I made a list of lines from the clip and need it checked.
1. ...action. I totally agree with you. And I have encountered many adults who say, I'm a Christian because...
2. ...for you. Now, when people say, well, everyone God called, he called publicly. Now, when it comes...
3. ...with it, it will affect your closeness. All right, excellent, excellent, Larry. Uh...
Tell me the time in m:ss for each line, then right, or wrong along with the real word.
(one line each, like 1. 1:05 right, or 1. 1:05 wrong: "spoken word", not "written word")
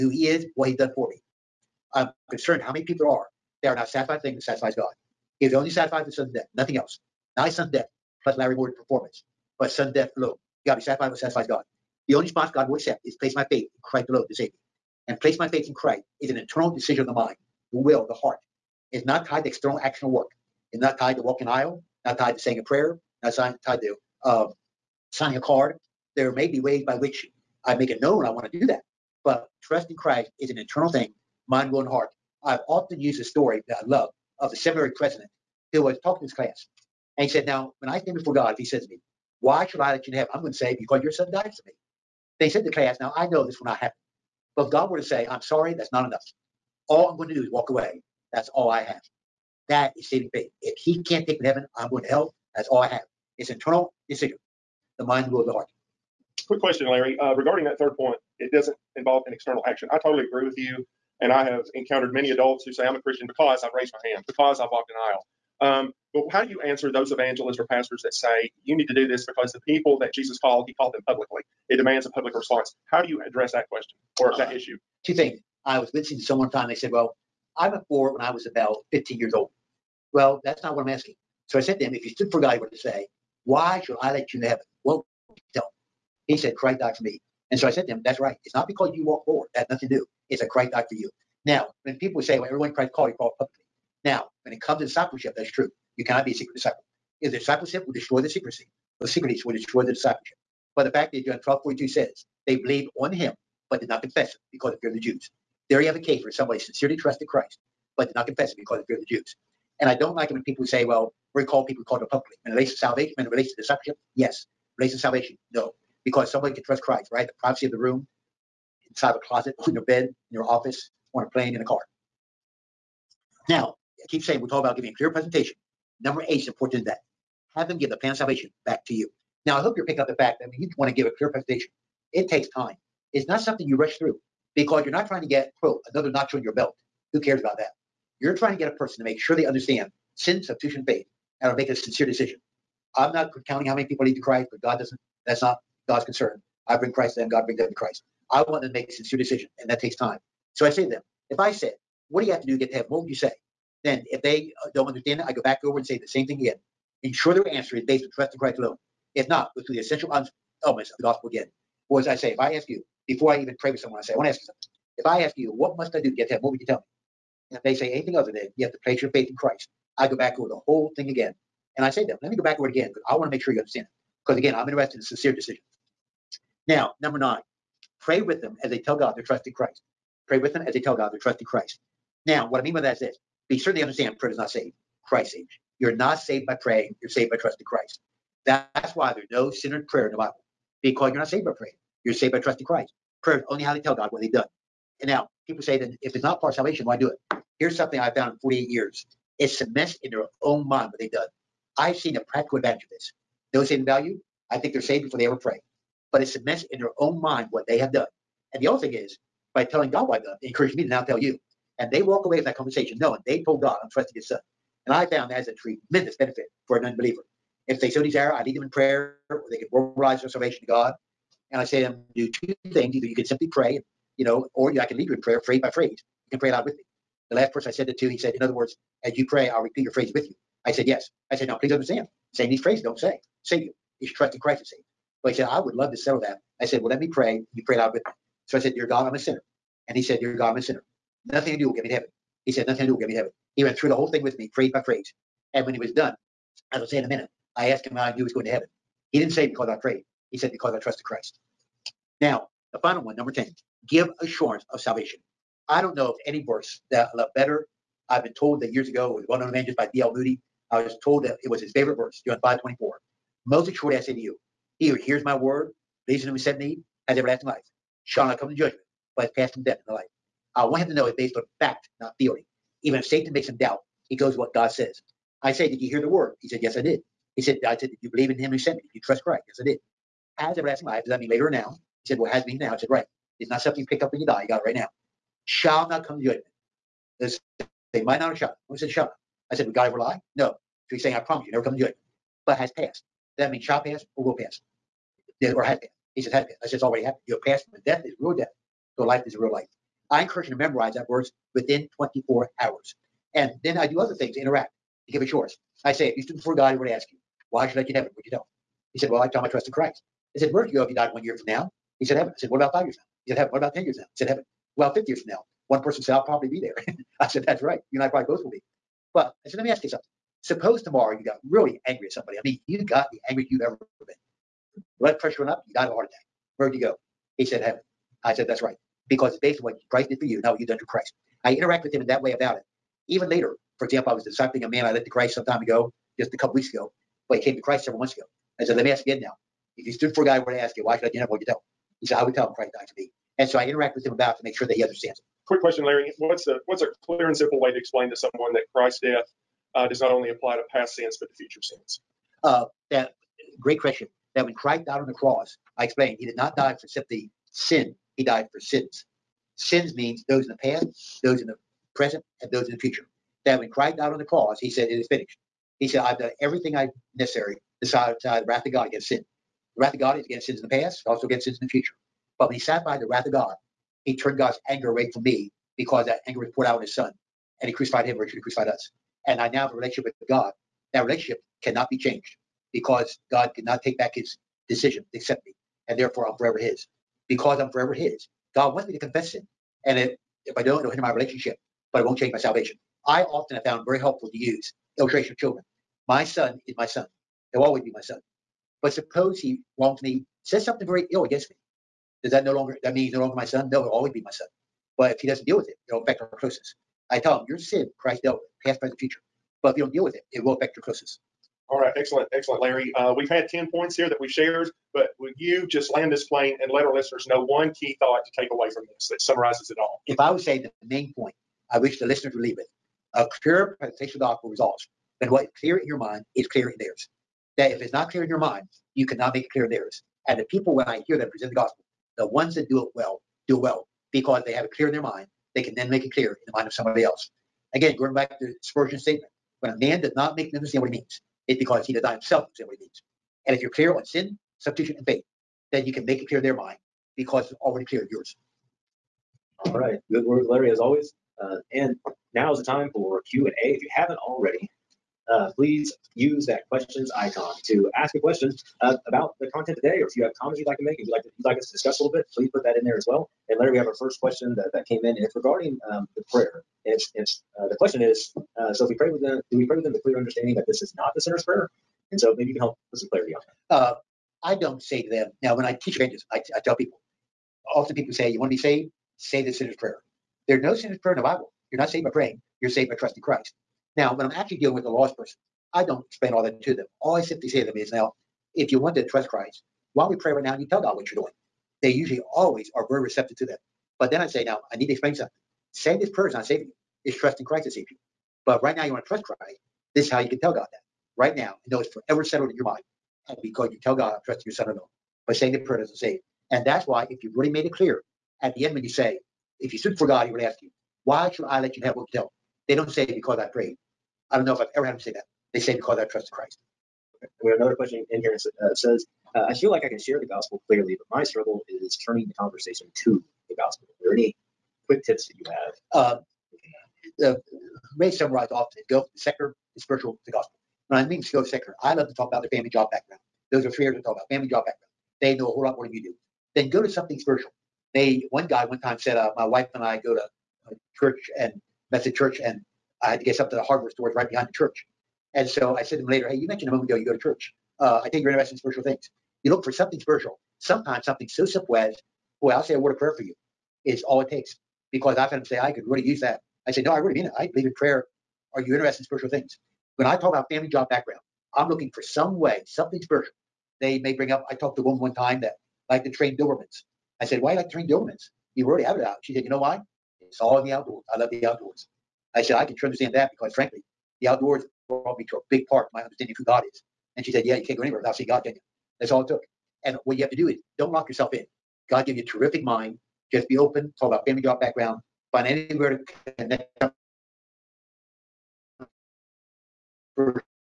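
1. 0:59 right
2. 1:30 wrong: "Christ", not "God"
3. 6:50 right.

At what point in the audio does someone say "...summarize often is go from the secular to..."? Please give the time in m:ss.
8:48.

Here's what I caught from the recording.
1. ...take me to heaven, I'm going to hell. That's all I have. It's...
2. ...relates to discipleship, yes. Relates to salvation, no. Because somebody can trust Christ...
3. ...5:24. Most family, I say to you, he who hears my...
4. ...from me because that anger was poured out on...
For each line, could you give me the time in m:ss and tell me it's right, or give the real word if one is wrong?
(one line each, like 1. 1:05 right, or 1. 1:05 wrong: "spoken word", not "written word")
1. 0:51 right
2. 1:53 right
3. 4:22 wrong: "assuredly", not "family"
4. 6:15 right.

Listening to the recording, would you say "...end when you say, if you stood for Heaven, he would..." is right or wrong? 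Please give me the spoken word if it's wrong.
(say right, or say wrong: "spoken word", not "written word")
wrong: "God", not "Heaven".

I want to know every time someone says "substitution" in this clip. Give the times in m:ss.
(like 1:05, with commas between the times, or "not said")
2:20, 7:24.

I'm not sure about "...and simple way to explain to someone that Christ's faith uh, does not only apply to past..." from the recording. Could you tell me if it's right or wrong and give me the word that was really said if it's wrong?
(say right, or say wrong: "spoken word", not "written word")
wrong: "death", not "faith".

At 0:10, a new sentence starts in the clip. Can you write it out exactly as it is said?
You gotta be satisfied what satisfies God.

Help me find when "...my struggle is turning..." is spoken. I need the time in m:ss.
8:41.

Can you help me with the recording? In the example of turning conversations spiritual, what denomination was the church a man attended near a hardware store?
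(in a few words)
Methodist.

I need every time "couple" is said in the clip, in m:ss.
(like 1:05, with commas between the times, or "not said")
5:36.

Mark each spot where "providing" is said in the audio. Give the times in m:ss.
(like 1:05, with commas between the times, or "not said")
not said.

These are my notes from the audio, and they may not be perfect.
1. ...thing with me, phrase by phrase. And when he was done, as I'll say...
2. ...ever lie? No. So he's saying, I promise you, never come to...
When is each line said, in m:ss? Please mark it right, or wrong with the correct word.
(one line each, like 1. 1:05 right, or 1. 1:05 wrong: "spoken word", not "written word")
1. 4:04 right
2. 4:49 right.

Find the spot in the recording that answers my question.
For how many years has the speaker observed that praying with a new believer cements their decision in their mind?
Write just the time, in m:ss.
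3:18.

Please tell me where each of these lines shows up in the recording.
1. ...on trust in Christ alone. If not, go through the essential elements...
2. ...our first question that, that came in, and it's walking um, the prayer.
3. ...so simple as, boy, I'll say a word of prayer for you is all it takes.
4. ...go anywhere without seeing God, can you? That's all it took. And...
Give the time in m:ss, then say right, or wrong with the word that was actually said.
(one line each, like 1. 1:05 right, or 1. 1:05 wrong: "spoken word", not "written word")
1. 2:38 right
2. 7:43 wrong: "regarding", not "walking"
3. 9:11 right
4. 9:37 right.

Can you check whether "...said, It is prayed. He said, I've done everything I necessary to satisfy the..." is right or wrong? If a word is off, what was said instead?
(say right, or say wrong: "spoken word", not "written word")
wrong: "finished", not "prayed".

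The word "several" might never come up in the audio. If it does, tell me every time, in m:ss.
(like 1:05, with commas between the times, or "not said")
5:37.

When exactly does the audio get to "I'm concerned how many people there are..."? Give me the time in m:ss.
0:01.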